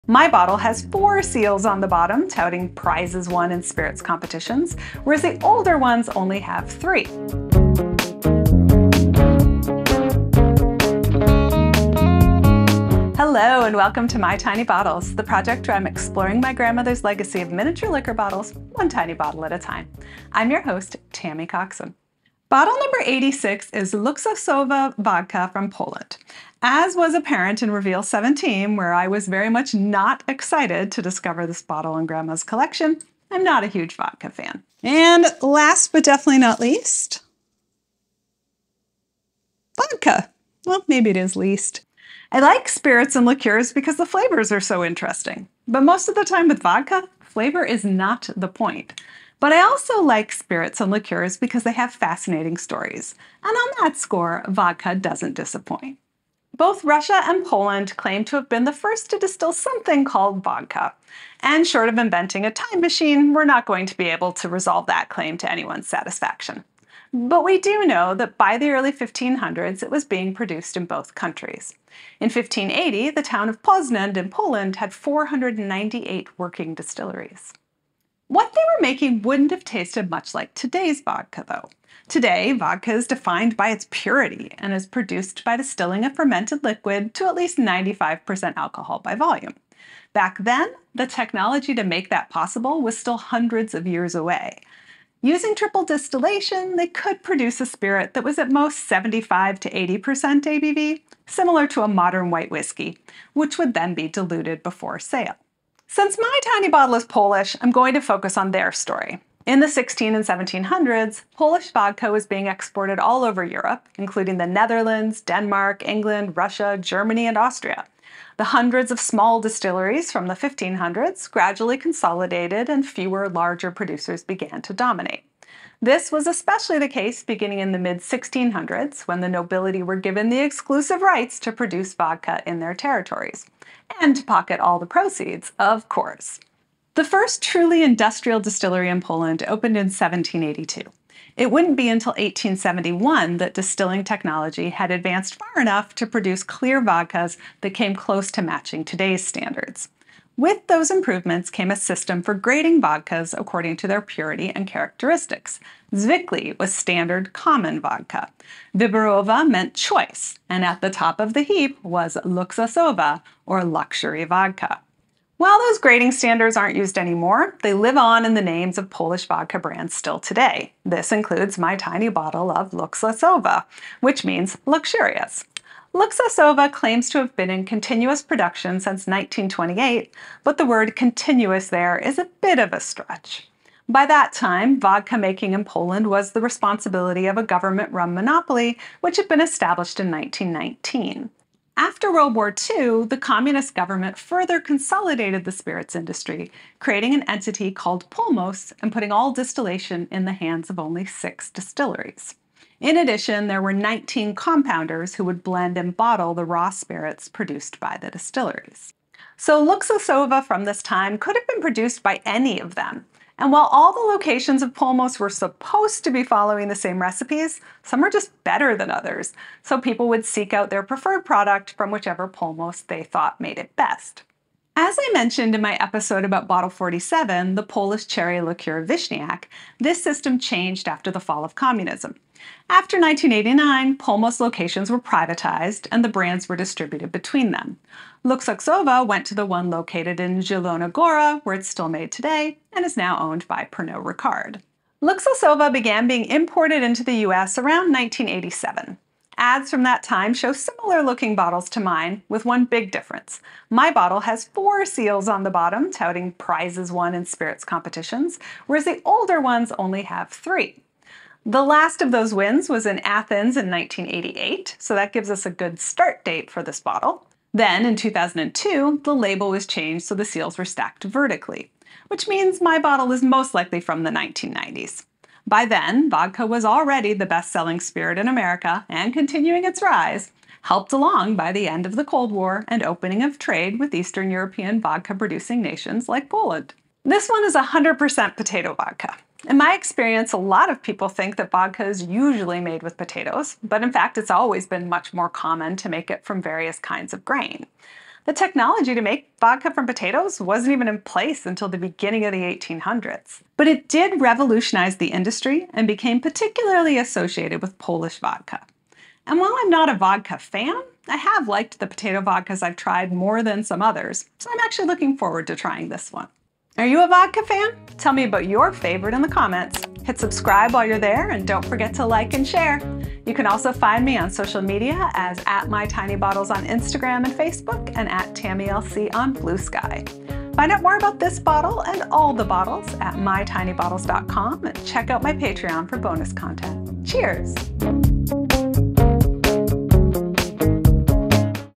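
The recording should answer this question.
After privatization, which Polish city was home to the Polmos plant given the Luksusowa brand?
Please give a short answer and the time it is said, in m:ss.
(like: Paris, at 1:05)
Zielona Gora, at 4:00.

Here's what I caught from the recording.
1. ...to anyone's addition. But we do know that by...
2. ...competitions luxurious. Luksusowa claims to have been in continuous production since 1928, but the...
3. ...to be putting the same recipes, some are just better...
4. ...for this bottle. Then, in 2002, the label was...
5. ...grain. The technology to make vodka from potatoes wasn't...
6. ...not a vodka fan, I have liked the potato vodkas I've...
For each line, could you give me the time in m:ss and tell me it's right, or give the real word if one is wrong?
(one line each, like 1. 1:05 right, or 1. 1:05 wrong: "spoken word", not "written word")
1. 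1:05 wrong: "satisfaction", not "addition"
2. 2:54 wrong: "means", not "competitions"
3. 3:36 wrong: "following", not "putting"
4. 4:26 right
5. 4:57 right
6. 5:09 right.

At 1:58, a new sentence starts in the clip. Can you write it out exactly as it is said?
The hundreds of small distilleries from the 1500s gradually consolidated and fewer larger producers began to dominate.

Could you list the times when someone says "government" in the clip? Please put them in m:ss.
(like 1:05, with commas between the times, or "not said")
3:07, 3:13.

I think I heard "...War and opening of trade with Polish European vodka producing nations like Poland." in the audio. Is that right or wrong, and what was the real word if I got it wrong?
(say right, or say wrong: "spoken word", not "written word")
wrong: "Eastern", not "Polish".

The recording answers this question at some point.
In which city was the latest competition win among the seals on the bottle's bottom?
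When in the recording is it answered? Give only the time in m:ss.
4:22.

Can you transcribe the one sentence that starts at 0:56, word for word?
Both Russia and Poland claim to have been the first to distill something called vodka.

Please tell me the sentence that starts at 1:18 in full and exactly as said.
What they were making wouldn't have tasted much like today's vodka, though.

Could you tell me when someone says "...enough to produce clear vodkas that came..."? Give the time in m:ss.
2:25.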